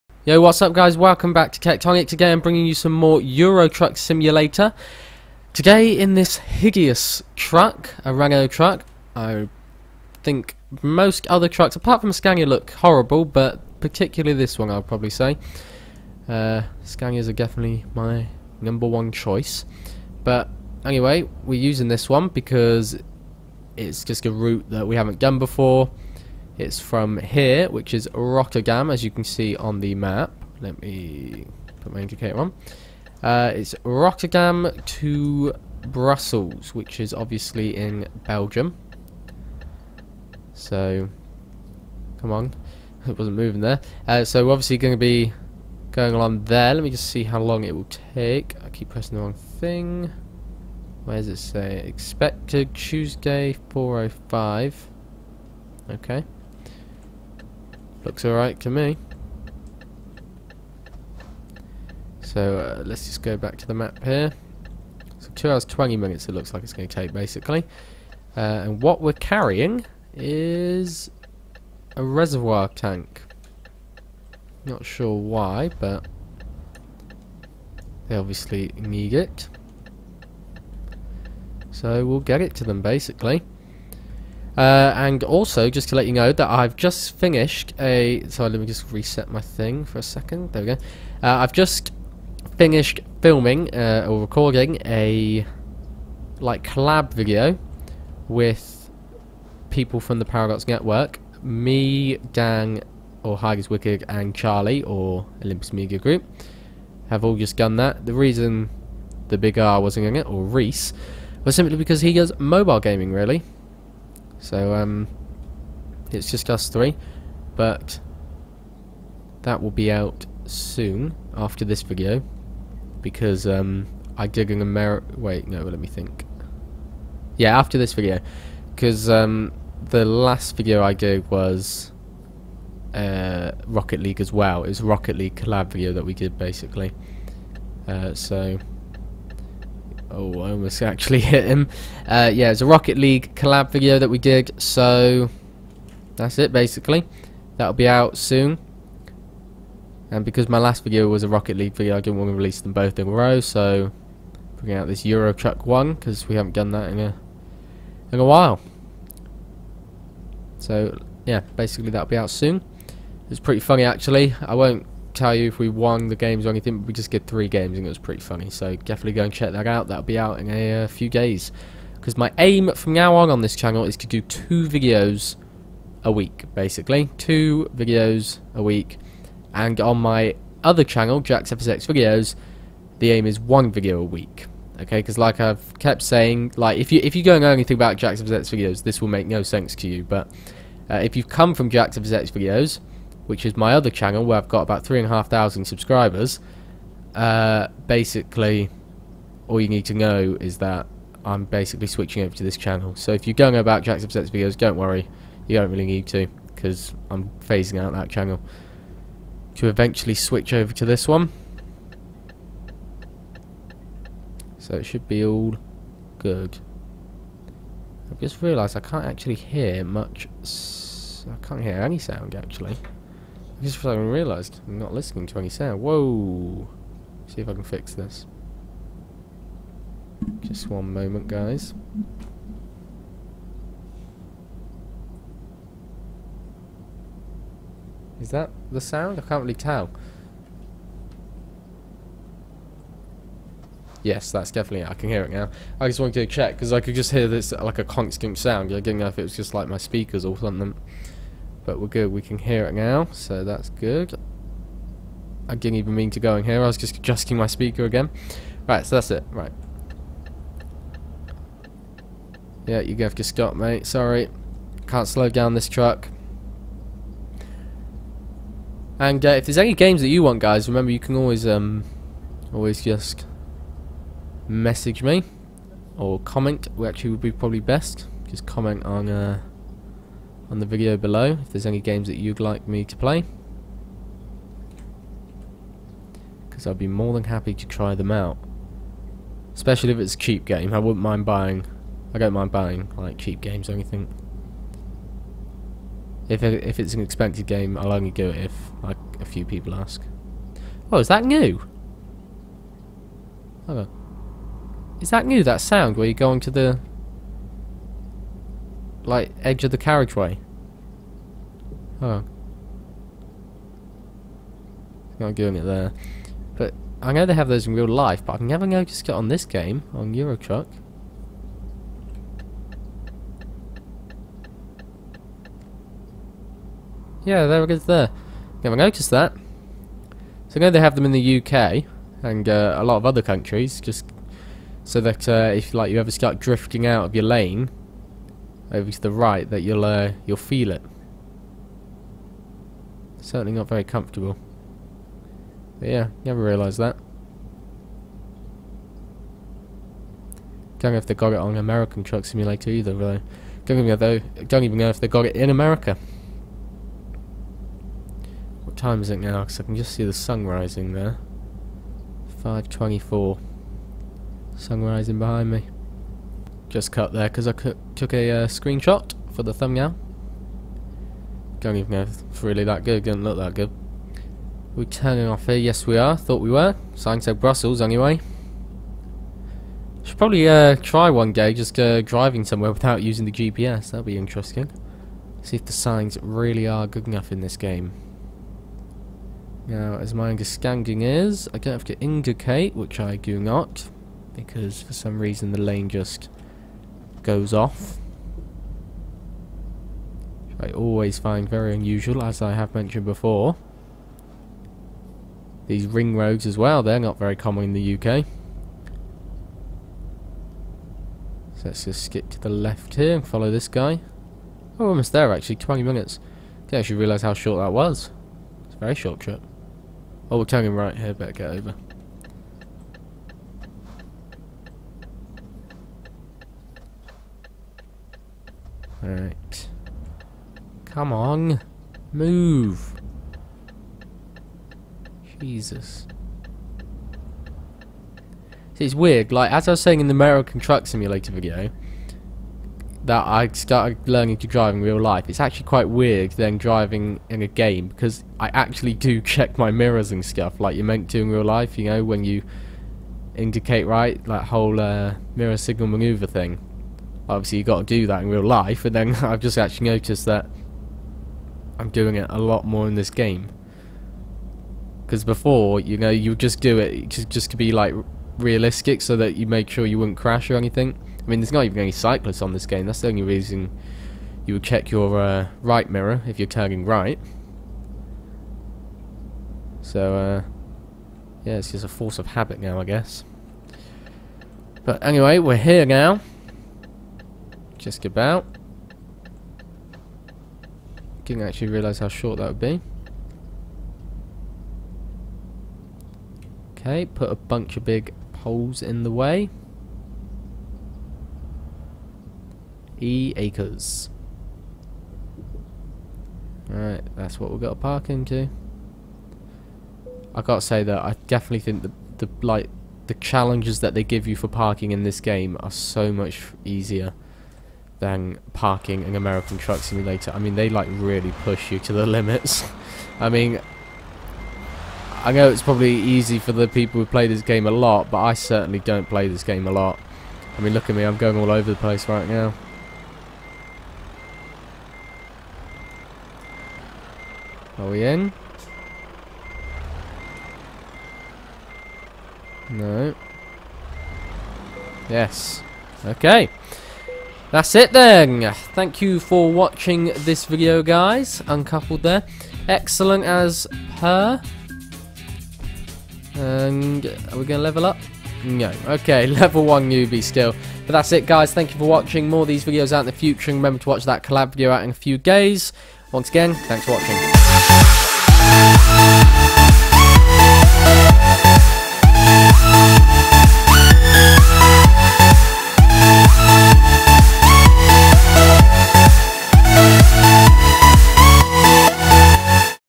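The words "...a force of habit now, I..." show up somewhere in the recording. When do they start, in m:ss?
8:01.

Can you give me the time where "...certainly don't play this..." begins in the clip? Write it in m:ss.
8:48.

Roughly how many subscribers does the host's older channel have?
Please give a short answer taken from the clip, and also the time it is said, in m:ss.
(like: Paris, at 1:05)
3,500, at 3:14.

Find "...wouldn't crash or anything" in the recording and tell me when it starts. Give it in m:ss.
7:49.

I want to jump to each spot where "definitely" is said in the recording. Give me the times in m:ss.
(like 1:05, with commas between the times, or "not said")
0:17, 2:48, 4:04, 8:31.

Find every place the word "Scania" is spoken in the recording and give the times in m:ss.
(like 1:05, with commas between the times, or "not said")
0:12, 0:16.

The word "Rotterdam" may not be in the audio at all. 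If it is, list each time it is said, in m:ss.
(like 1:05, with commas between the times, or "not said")
0:28, 0:33.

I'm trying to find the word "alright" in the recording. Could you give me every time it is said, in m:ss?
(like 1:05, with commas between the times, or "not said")
0:58, 7:09, 8:26.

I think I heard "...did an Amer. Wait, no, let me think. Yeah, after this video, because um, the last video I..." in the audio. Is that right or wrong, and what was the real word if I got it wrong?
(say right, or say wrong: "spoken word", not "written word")
right.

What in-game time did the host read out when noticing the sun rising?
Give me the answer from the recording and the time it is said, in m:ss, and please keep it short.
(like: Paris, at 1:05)
5:24, at 6:02.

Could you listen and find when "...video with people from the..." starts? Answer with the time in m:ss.
1:37.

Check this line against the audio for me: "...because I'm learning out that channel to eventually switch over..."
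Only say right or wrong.
wrong.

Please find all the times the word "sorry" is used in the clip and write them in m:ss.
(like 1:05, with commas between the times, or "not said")
1:28, 4:23.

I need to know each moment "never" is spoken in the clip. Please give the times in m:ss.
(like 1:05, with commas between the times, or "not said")
5:18, 5:28, 5:46.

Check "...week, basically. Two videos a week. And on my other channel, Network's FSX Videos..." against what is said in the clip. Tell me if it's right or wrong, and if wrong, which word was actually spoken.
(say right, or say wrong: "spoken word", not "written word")
wrong: "Jack", not "Network".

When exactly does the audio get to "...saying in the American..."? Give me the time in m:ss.
7:19.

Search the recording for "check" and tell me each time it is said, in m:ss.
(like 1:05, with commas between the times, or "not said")
2:49, 4:06, 7:29, 7:54.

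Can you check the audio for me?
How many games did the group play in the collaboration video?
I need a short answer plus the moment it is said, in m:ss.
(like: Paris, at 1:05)
3, at 2:47.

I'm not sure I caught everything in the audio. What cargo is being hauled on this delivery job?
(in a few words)
A reservoir tank.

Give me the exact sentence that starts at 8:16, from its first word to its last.
Okay, put a bunch of big poles in the way.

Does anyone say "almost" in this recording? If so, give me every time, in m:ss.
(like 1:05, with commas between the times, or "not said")
2:20, 6:54.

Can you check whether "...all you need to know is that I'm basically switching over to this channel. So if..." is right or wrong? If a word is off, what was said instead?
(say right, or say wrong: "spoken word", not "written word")
right.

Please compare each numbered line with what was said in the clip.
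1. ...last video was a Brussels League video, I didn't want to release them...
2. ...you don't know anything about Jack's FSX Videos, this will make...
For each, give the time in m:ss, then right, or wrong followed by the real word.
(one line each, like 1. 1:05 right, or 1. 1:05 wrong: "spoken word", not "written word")
1. 2:30 wrong: "Rocket", not "Brussels"
2. 3:07 right.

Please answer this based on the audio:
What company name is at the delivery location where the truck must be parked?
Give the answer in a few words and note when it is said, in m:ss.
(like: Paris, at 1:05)
E acres, at 8:23.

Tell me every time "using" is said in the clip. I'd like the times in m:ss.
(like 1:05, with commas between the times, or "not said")
0:21, 6:23.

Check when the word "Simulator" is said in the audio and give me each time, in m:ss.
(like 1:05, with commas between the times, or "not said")
0:03, 5:52, 7:20, 8:39.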